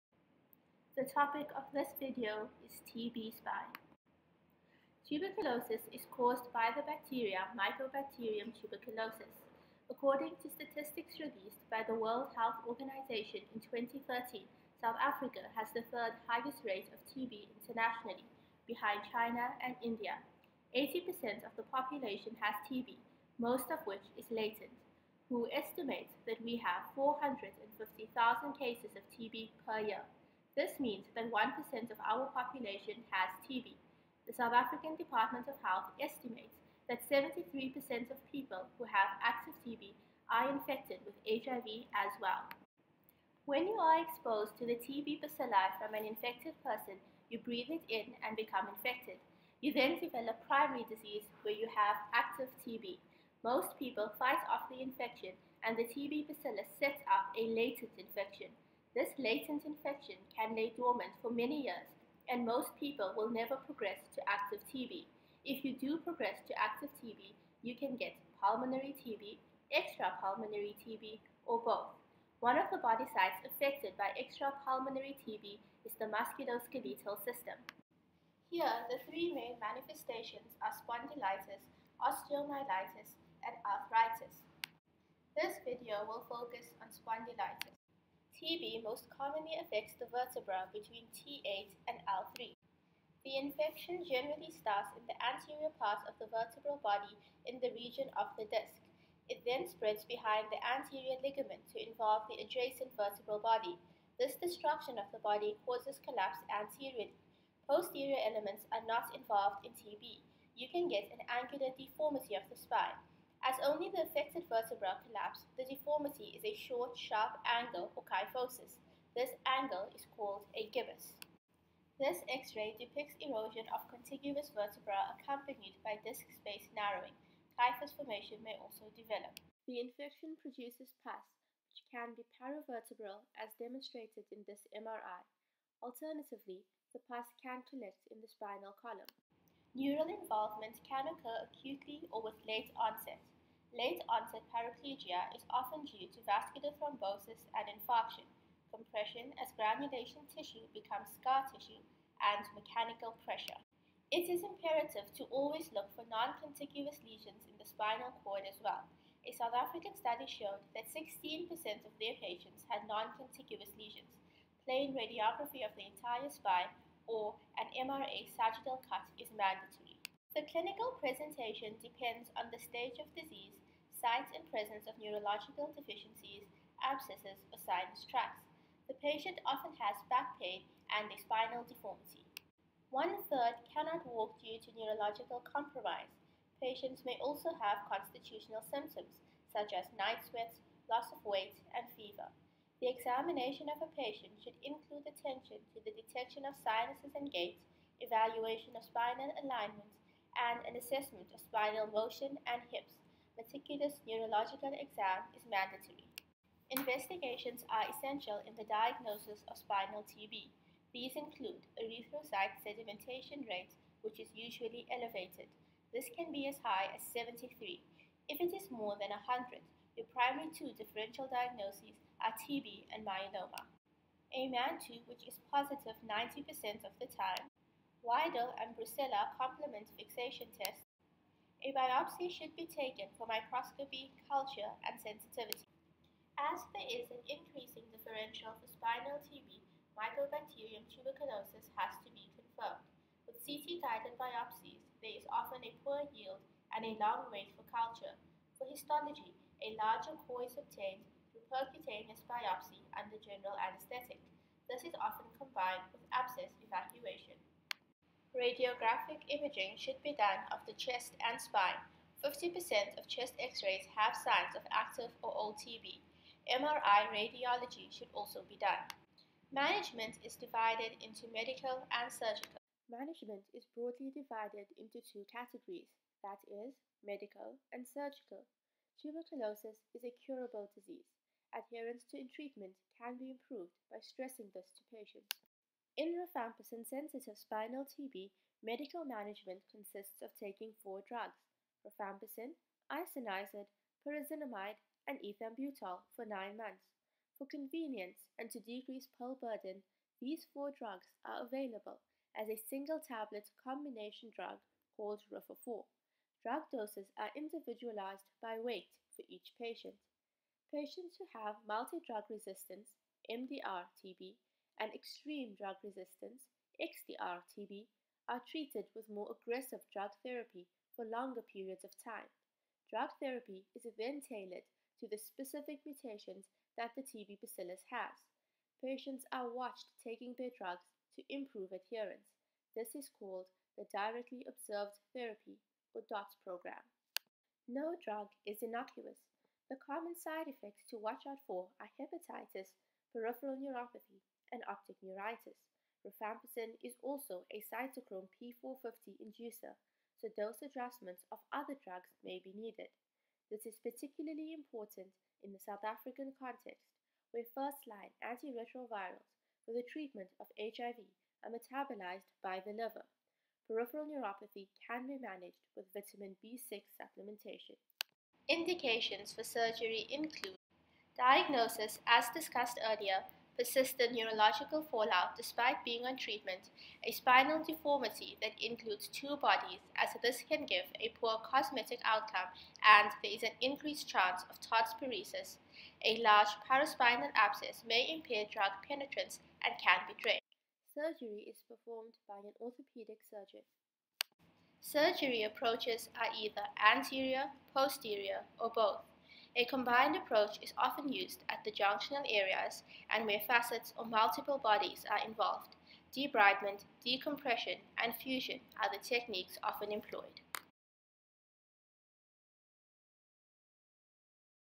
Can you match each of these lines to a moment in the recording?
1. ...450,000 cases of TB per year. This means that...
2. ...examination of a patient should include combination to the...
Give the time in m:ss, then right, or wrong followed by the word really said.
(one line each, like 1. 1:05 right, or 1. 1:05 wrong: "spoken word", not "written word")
1. 0:26 right
2. 3:12 wrong: "attention", not "combination".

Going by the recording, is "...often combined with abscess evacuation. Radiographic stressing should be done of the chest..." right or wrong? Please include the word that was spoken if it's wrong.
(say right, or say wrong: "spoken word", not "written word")
wrong: "imaging", not "stressing".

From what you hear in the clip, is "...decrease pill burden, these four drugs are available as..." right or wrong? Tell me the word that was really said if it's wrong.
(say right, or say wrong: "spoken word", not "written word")
right.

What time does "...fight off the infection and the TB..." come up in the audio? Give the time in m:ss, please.
0:54.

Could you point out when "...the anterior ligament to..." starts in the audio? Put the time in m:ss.
1:40.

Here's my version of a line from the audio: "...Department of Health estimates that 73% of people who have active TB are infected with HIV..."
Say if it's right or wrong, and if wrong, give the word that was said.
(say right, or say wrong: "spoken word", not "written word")
right.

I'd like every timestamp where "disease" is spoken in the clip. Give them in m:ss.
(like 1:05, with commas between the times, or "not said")
0:50, 2:53, 4:40.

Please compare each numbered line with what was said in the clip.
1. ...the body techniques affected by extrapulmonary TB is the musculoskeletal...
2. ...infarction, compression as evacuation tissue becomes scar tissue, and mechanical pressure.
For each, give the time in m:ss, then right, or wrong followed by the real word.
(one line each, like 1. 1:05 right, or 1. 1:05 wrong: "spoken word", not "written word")
1. 1:12 wrong: "sites", not "techniques"
2. 2:27 wrong: "granulation", not "evacuation".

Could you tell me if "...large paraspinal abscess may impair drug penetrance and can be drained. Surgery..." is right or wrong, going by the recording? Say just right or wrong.
right.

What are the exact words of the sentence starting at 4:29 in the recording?
Management is divided into medical and surgical.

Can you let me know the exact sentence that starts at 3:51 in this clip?
A biopsy should be taken for microscopy, culture, and sensitivity.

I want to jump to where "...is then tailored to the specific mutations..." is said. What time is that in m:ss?
5:23.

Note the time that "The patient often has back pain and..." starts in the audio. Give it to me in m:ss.
2:58.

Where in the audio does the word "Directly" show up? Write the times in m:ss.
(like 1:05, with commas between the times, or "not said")
5:33.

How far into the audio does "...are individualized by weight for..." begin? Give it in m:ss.
5:07.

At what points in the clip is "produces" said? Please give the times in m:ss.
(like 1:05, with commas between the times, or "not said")
2:10.